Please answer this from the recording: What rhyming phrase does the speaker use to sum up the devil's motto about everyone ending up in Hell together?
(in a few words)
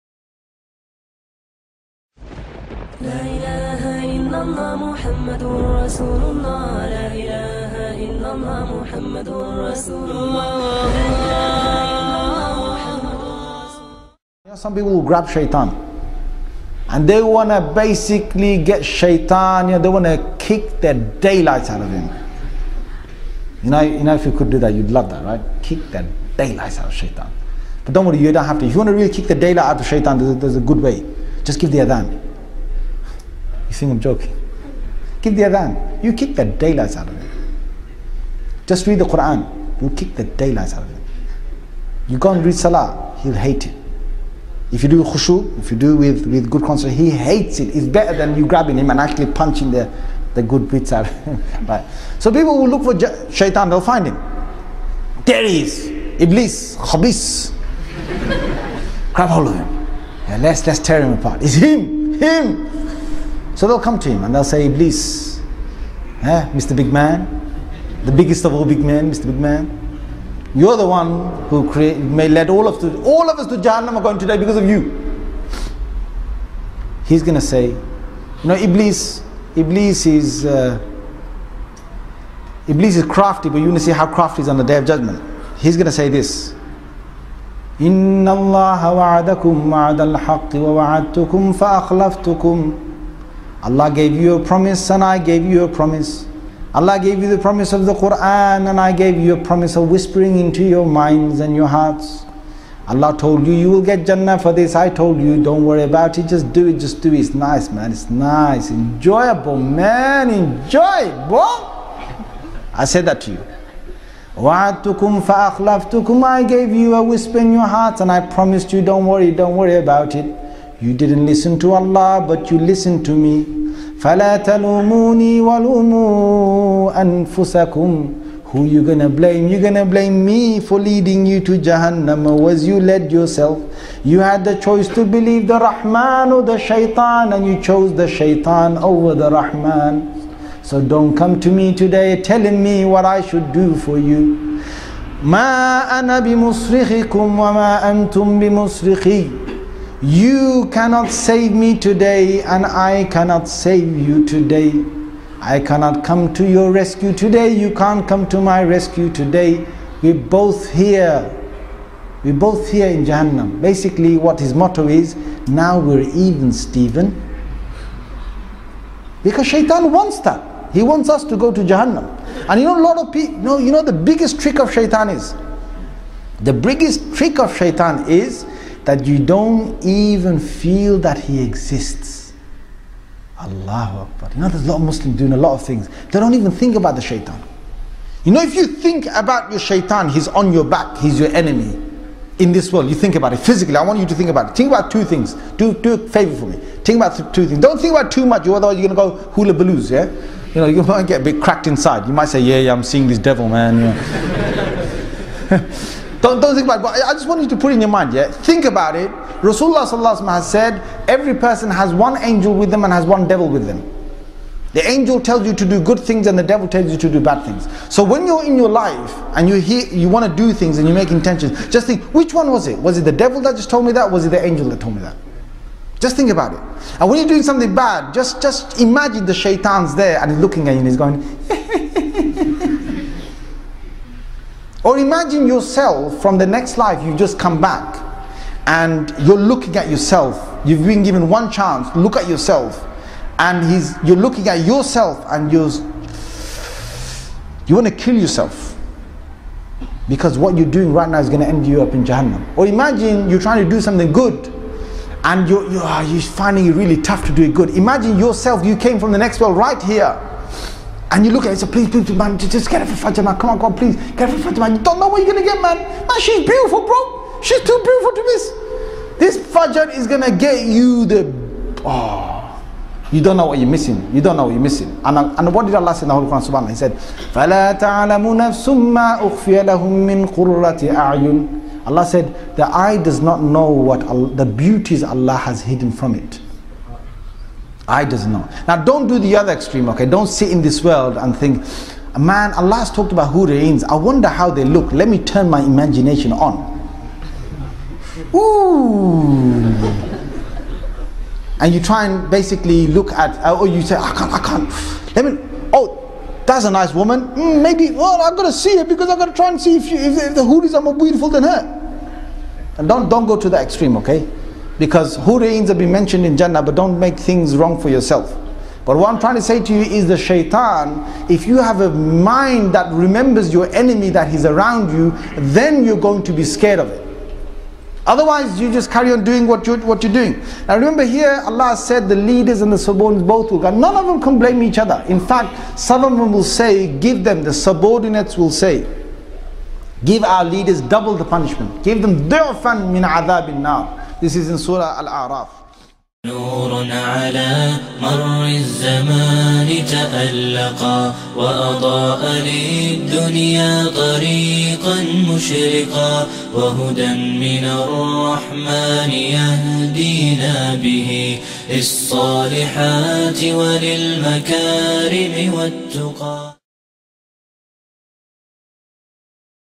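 We're even, Stephen.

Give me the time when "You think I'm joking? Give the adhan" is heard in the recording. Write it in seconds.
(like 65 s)
33 s.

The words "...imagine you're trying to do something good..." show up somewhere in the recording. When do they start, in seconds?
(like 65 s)
252 s.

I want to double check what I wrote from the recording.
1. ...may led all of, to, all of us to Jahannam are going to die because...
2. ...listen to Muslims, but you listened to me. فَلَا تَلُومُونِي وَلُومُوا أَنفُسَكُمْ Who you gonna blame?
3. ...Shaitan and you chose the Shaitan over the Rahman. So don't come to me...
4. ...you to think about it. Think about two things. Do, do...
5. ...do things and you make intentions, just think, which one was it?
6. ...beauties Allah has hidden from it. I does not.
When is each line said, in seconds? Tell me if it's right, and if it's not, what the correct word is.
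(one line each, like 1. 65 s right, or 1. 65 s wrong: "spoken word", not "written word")
1. 71 s right
2. 121 s wrong: "Allah", not "Muslims"
3. 136 s right
4. 193 s right
5. 220 s right
6. 284 s right.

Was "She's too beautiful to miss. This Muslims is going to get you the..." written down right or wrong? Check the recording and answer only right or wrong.
wrong.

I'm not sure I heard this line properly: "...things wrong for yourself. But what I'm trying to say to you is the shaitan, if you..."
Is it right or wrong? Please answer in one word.
right.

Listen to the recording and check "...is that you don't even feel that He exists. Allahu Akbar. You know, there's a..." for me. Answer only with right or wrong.
right.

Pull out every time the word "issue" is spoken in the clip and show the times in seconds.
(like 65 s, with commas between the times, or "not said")
not said.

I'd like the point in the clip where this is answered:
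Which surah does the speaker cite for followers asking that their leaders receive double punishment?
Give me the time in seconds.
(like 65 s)
344 s.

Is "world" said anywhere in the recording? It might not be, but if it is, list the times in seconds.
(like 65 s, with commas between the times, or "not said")
192 s, 259 s, 290 s.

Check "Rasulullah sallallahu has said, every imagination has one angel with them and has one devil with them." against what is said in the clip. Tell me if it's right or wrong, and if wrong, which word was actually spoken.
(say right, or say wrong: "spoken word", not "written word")
wrong: "person", not "imagination".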